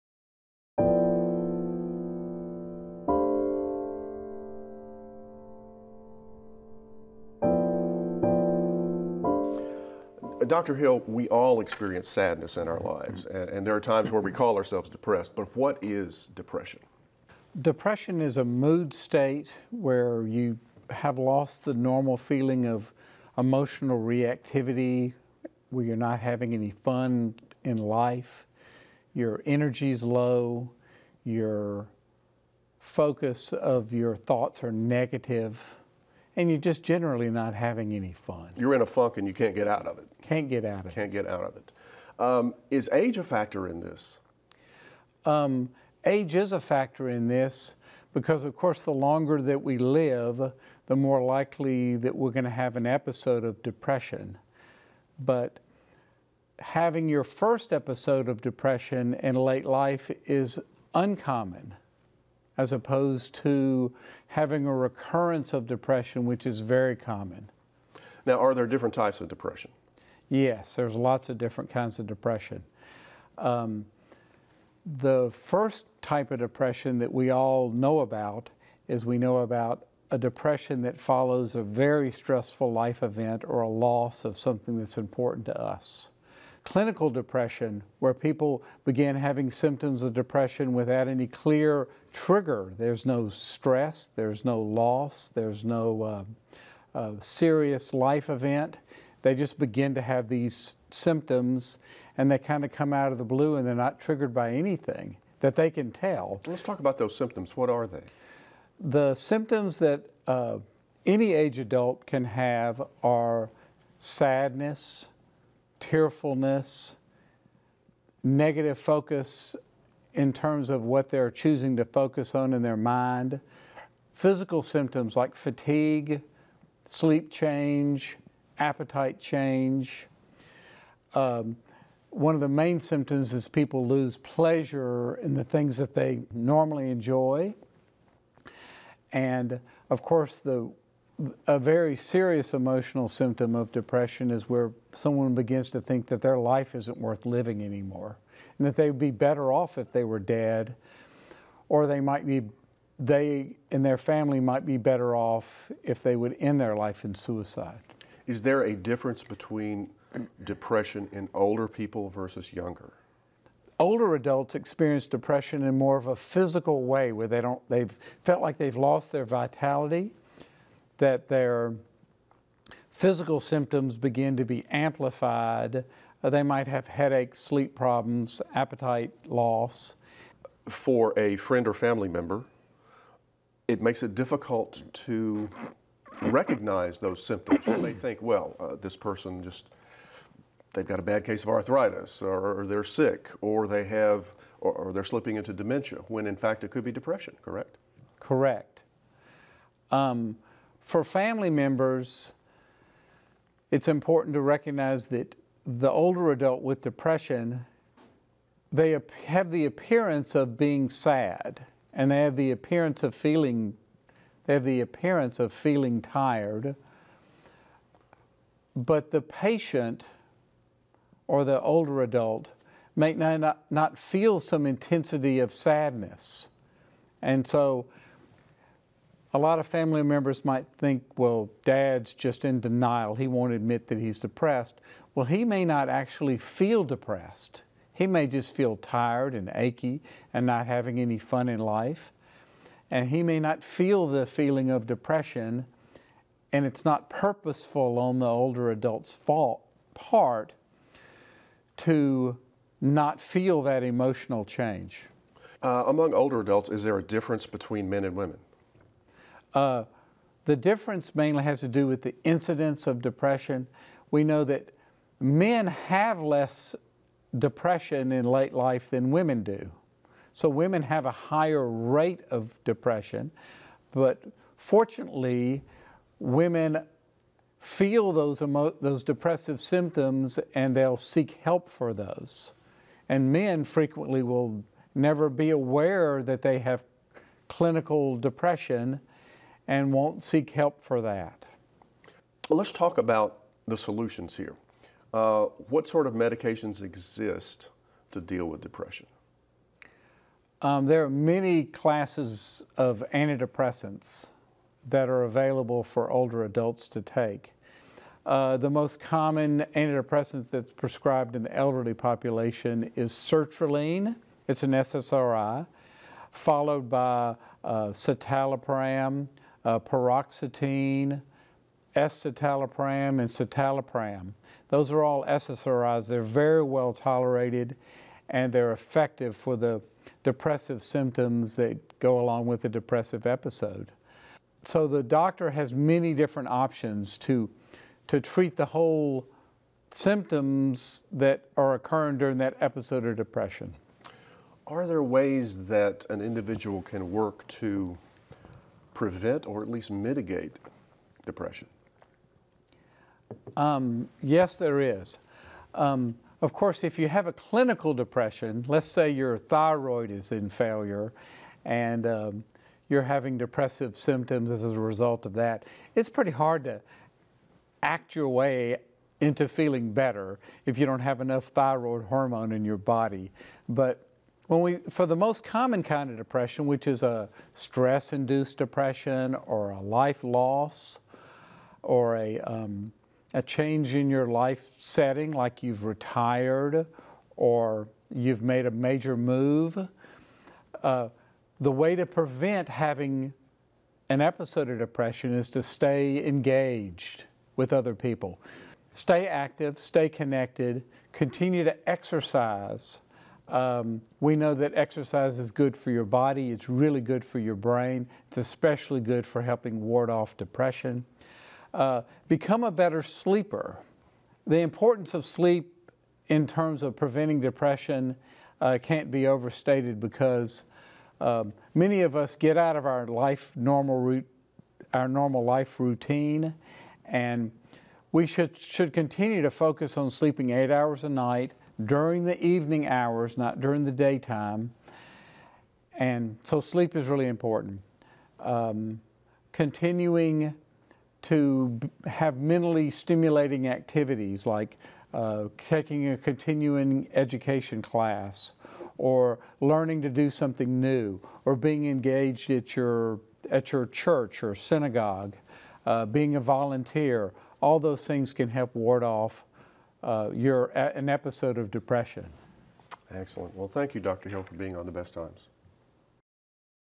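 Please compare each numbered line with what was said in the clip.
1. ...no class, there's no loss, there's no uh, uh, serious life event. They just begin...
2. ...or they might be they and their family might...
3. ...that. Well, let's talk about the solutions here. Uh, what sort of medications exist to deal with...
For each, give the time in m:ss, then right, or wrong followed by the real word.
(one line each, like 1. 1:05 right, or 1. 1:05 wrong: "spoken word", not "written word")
1. 1:33 wrong: "stress", not "class"
2. 2:31 right
3. 4:51 right.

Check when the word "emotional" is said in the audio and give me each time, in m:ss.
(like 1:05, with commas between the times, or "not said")
0:23, 2:22, 4:13.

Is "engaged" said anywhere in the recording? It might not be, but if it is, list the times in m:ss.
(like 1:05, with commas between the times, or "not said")
6:36, 7:31.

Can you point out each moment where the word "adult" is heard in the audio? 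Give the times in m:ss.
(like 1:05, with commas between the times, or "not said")
1:51, 2:44, 3:26, 3:42, 4:08, 4:16, 5:06.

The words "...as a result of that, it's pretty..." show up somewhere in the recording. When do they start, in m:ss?
6:04.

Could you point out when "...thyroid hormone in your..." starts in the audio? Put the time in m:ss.
6:11.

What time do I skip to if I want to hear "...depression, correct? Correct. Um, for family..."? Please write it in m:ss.
3:16.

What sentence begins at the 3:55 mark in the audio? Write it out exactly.
Well, he may not actually feel depressed.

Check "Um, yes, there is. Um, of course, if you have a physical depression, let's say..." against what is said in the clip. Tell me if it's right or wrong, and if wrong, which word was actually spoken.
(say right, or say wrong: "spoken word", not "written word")
wrong: "clinical", not "physical".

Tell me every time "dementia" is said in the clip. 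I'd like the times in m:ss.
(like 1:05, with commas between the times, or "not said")
3:15.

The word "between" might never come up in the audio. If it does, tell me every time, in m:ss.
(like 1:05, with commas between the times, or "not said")
2:39, 4:17.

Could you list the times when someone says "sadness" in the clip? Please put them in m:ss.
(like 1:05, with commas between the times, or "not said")
0:12, 1:53, 3:45.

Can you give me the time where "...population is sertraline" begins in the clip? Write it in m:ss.
5:11.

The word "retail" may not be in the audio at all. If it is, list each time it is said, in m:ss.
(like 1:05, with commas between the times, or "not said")
not said.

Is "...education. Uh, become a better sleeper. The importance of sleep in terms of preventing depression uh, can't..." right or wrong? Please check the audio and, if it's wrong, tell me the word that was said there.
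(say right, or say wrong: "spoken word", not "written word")
wrong: "depression", not "education".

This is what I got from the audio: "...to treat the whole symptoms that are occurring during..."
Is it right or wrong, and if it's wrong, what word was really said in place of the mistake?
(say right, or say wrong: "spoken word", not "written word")
right.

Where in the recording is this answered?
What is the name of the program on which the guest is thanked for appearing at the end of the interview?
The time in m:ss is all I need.
7:44.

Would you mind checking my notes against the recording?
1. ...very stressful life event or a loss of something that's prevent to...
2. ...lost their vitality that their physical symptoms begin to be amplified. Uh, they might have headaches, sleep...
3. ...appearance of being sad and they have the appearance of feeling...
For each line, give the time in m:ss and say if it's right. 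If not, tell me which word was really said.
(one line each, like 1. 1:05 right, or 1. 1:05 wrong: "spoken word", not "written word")
1. 1:21 wrong: "important", not "prevent"
2. 2:48 right
3. 3:29 right.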